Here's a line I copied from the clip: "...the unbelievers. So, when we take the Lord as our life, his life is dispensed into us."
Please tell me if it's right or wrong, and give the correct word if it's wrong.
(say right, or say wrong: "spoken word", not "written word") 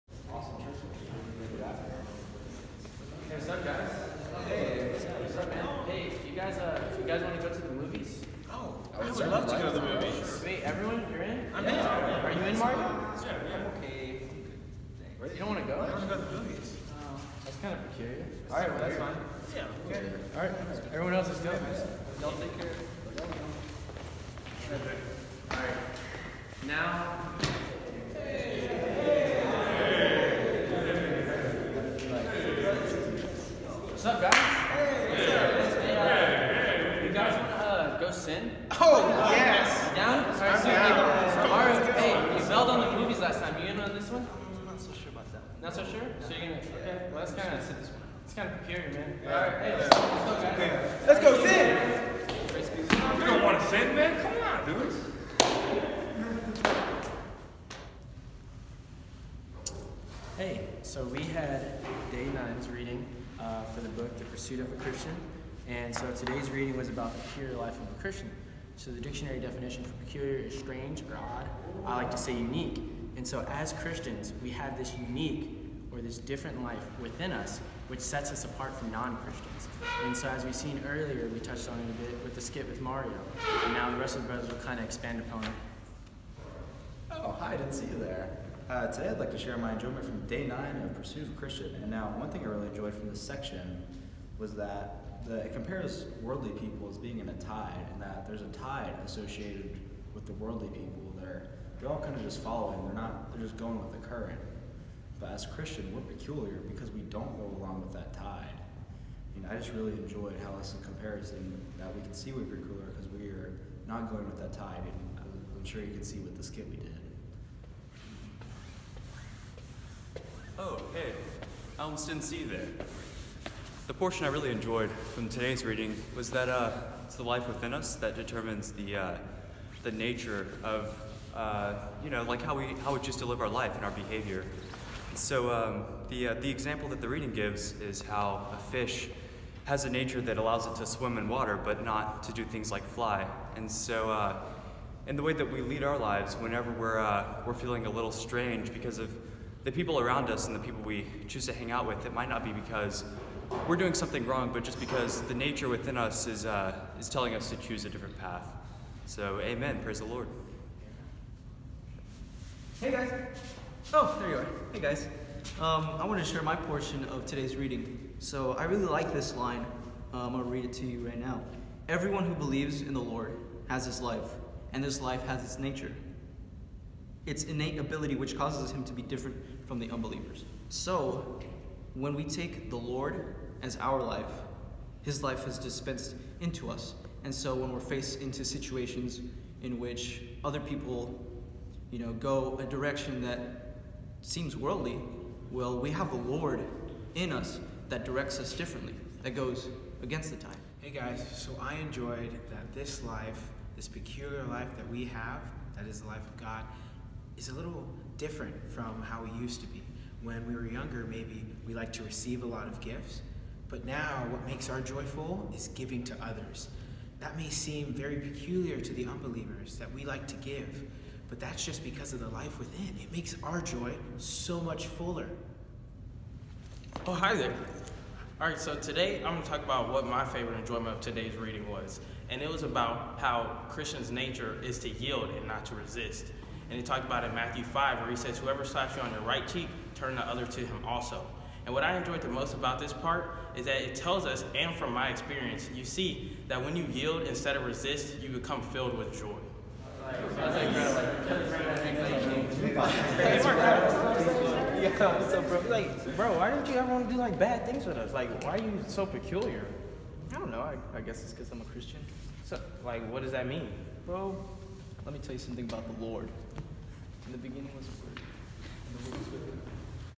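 right.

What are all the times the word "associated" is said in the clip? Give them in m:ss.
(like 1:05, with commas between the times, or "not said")
1:39.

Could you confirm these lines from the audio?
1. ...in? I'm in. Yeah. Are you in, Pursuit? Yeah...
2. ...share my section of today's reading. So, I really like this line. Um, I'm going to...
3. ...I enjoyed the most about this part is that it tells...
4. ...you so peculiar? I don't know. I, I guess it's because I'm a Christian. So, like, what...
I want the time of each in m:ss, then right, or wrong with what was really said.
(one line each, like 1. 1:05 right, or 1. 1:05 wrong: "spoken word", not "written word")
1. 0:11 wrong: "Mario", not "Pursuit"
2. 2:46 wrong: "portion", not "section"
3. 4:01 right
4. 4:18 right.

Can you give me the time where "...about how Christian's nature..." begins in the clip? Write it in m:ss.
3:52.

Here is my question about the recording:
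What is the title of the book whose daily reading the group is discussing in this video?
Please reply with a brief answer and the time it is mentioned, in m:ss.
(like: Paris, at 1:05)
The Pursuit of a Christian, at 1:04.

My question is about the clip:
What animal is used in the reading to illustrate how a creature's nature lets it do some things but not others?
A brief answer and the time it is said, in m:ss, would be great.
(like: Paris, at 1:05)
A fish, at 2:18.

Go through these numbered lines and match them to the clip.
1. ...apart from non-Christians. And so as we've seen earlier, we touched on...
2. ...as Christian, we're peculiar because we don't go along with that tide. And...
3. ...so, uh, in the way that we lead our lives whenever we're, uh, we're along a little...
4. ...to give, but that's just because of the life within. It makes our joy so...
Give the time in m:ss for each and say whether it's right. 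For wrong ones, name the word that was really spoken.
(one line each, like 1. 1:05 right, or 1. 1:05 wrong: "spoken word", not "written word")
1. 1:18 right
2. 1:45 right
3. 2:23 wrong: "feeling", not "along"
4. 3:40 right.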